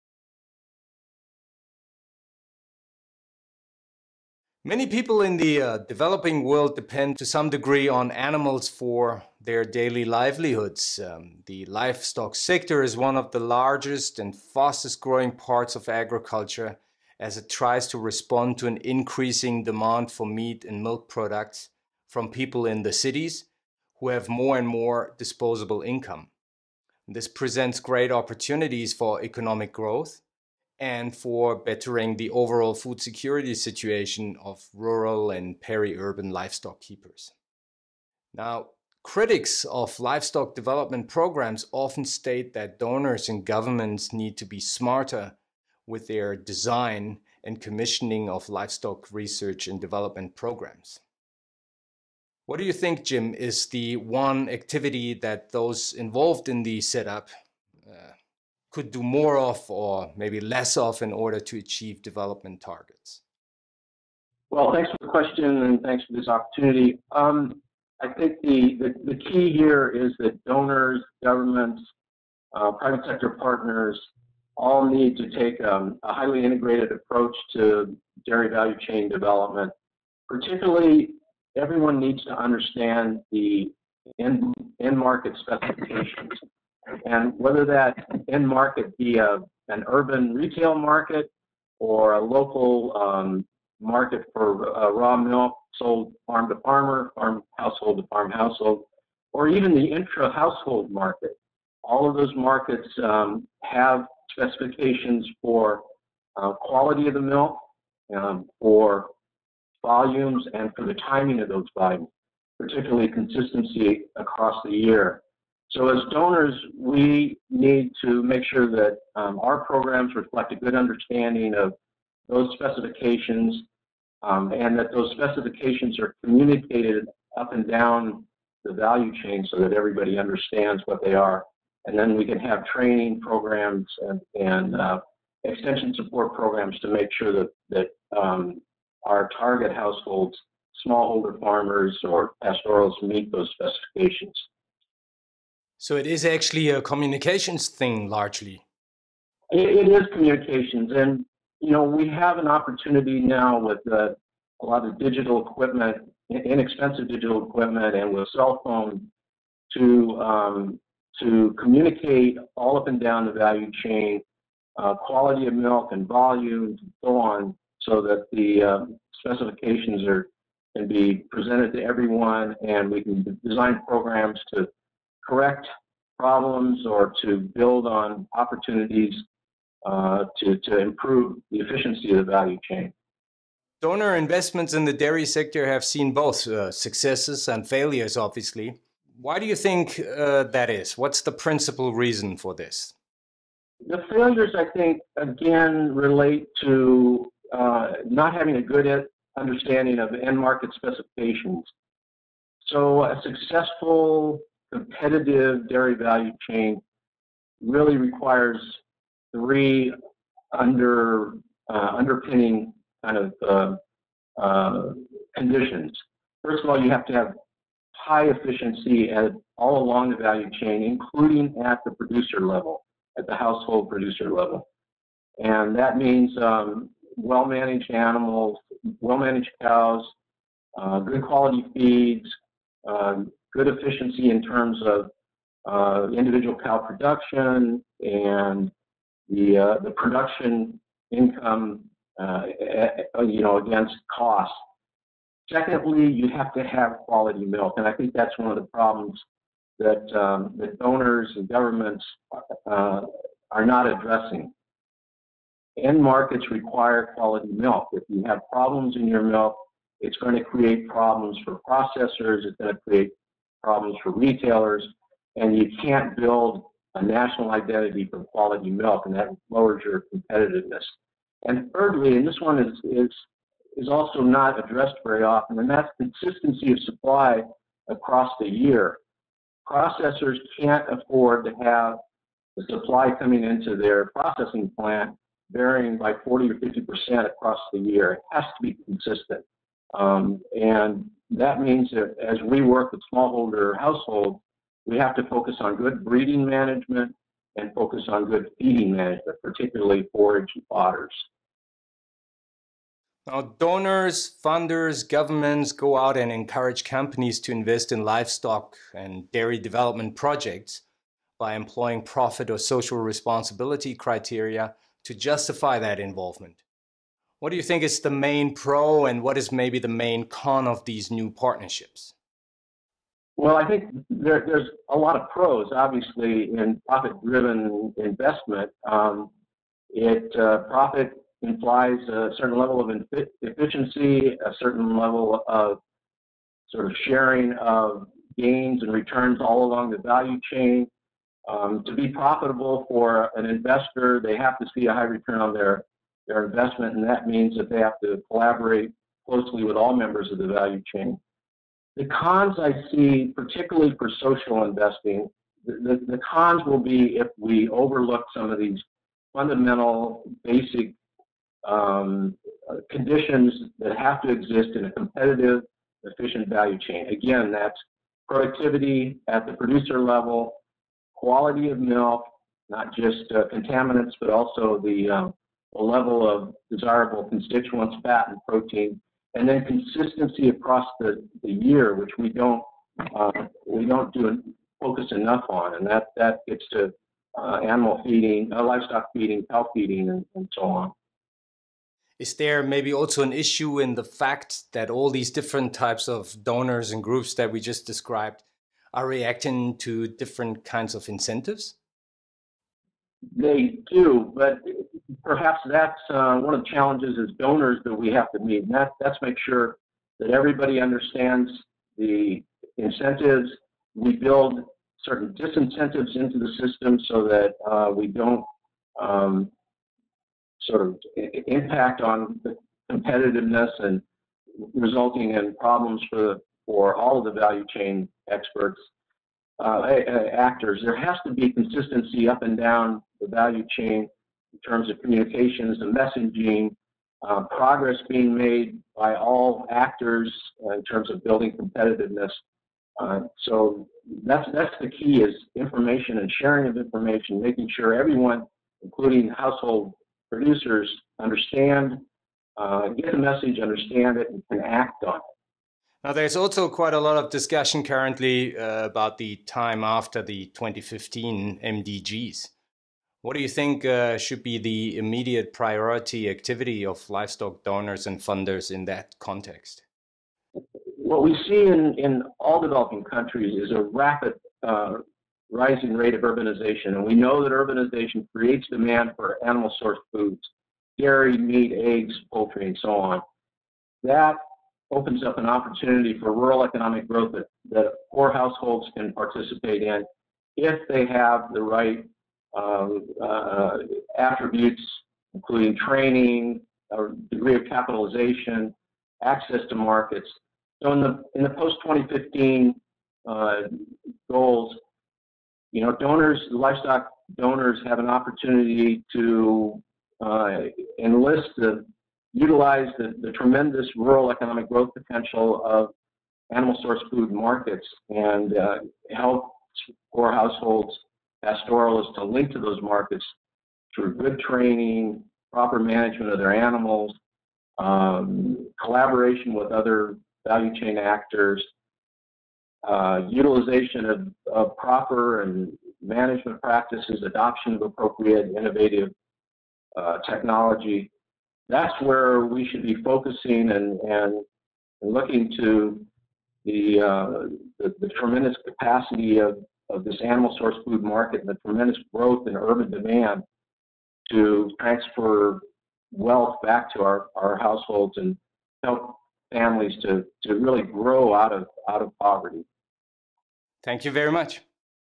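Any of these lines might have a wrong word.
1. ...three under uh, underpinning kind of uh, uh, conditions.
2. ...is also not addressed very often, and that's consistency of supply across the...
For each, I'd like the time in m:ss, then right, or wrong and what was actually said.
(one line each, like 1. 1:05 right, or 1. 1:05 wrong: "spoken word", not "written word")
1. 3:29 right
2. 4:33 right.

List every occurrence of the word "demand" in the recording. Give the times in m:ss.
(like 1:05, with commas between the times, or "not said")
0:19, 7:58, 9:12.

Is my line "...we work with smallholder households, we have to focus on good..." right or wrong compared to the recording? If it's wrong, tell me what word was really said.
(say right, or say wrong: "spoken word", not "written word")
right.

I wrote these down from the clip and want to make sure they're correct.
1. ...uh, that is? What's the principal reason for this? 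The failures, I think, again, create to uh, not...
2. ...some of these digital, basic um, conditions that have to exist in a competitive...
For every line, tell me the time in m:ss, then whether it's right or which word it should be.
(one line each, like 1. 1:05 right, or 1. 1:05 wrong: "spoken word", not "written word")
1. 3:09 wrong: "relate", not "create"
2. 5:58 wrong: "fundamental", not "digital".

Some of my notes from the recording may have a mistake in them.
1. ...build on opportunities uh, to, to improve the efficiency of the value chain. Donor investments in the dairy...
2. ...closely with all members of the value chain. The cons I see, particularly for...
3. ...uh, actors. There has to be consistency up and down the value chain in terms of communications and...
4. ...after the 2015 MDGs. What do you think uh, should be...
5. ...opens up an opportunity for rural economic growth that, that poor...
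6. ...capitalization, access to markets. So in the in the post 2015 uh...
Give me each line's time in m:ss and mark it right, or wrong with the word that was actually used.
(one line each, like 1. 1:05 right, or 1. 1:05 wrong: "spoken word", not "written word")
1. 2:57 right
2. 5:49 right
3. 7:09 right
4. 7:39 right
5. 8:04 right
6. 8:17 right.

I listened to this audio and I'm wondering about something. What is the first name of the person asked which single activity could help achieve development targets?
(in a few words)
Jim.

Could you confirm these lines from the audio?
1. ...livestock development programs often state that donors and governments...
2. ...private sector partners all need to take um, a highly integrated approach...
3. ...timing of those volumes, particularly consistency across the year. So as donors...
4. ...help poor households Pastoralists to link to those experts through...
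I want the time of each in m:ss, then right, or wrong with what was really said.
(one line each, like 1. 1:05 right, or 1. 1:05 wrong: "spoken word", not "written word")
1. 0:39 right
2. 1:12 right
3. 1:50 right
4. 8:39 wrong: "markets", not "experts".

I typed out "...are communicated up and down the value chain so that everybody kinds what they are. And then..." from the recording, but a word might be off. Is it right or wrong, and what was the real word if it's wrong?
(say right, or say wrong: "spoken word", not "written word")
wrong: "understands", not "kinds".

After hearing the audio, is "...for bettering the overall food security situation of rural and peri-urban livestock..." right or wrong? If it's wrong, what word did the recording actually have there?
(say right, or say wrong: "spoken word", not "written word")
right.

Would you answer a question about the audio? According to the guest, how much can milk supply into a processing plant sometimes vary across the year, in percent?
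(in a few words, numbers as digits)
40 or 50 percent.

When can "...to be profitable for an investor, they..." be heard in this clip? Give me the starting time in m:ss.
5:41.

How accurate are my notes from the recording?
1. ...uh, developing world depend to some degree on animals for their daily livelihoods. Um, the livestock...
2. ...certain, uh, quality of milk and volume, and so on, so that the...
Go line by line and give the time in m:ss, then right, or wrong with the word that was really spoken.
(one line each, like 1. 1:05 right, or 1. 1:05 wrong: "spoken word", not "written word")
1. 0:05 right
2. 2:43 wrong: "chain", not "certain".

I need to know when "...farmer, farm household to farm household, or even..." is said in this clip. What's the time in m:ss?
1:36.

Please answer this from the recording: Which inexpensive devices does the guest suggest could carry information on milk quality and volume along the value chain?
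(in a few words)
cell phones.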